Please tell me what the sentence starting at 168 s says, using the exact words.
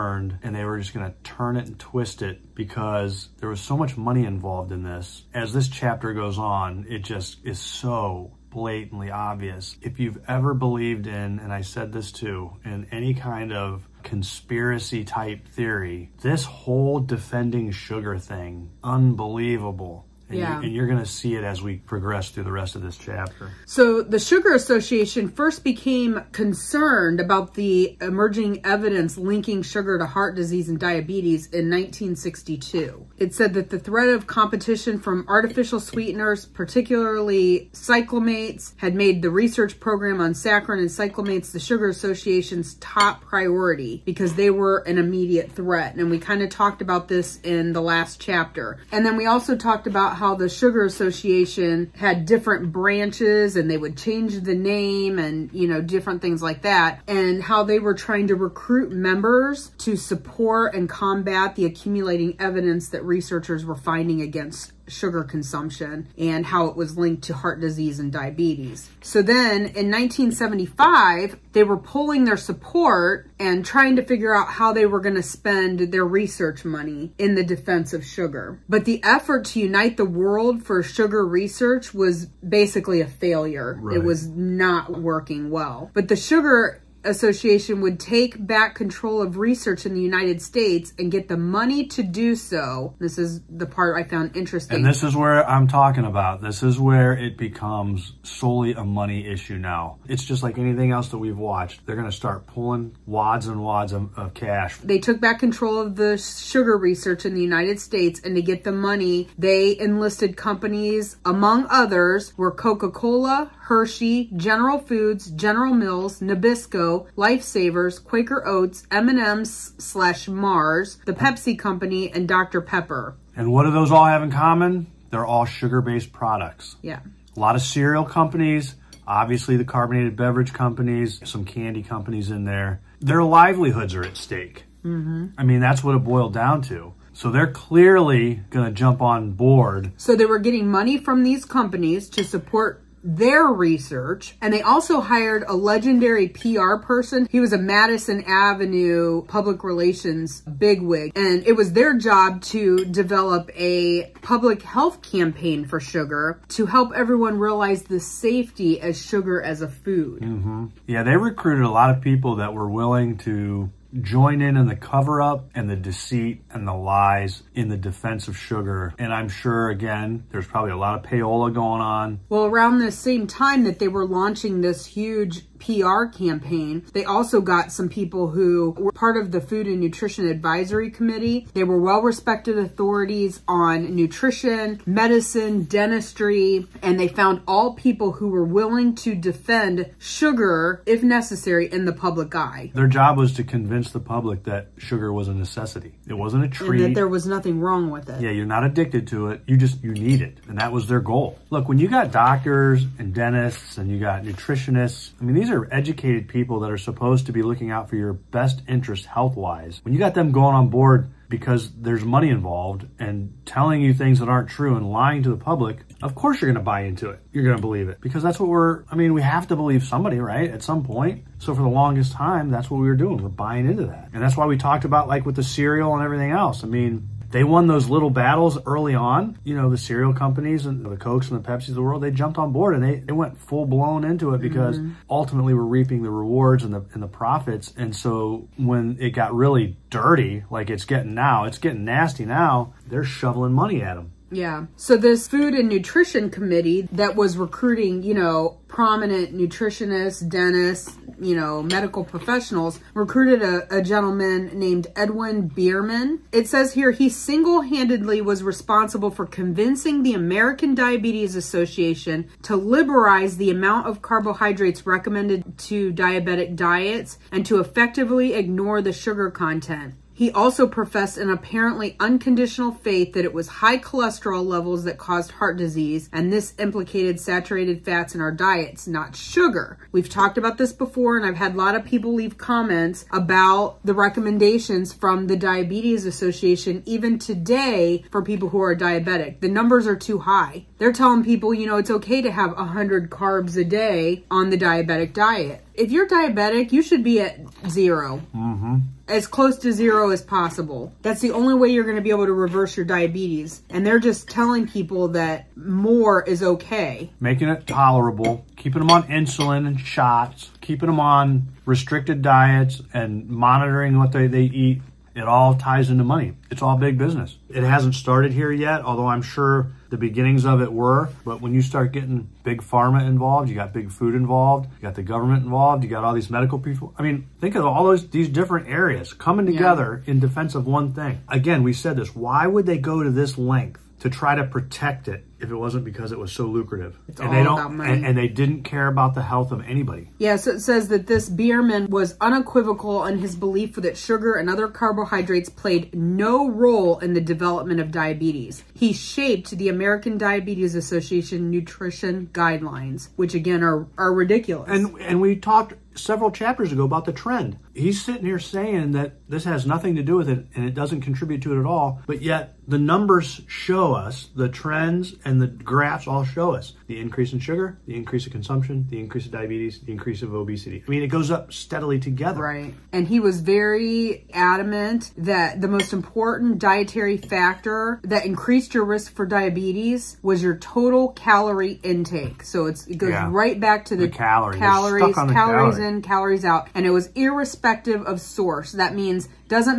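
And I'm sure, again, there's probably a lot of payola going on.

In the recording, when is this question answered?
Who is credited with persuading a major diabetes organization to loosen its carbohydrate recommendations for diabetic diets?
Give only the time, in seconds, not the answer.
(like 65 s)
254 s.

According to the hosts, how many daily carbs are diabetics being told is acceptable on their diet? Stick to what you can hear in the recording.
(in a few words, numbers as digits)
100.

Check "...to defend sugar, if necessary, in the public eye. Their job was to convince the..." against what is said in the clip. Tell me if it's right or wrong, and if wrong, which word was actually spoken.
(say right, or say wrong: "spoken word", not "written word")
right.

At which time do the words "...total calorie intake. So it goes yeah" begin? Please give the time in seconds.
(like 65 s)
380 s.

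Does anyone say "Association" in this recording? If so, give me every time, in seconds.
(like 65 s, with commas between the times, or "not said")
24 s, 41 s, 50 s, 87 s, 261 s, 286 s, 350 s.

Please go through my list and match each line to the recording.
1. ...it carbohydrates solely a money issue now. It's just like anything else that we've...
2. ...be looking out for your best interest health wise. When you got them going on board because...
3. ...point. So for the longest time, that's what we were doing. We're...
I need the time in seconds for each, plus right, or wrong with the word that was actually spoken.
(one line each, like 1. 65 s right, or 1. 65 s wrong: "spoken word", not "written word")
1. 97 s wrong: "becomes", not "carbohydrates"
2. 207 s right
3. 220 s right.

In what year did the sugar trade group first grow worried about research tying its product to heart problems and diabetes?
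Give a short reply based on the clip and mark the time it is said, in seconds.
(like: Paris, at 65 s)
1962, at 31 s.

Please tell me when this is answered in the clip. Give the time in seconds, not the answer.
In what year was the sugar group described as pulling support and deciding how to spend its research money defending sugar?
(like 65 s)
69 s.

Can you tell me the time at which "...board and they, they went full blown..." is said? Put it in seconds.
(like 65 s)
232 s.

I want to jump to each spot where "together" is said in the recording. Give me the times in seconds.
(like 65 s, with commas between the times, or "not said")
329 s, 371 s.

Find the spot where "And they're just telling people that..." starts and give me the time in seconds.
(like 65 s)
303 s.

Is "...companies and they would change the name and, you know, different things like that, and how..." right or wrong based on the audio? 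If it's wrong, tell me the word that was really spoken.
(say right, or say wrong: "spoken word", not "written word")
wrong: "branches", not "companies".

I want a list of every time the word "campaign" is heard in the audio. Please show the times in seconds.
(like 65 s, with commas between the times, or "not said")
155 s, 176 s.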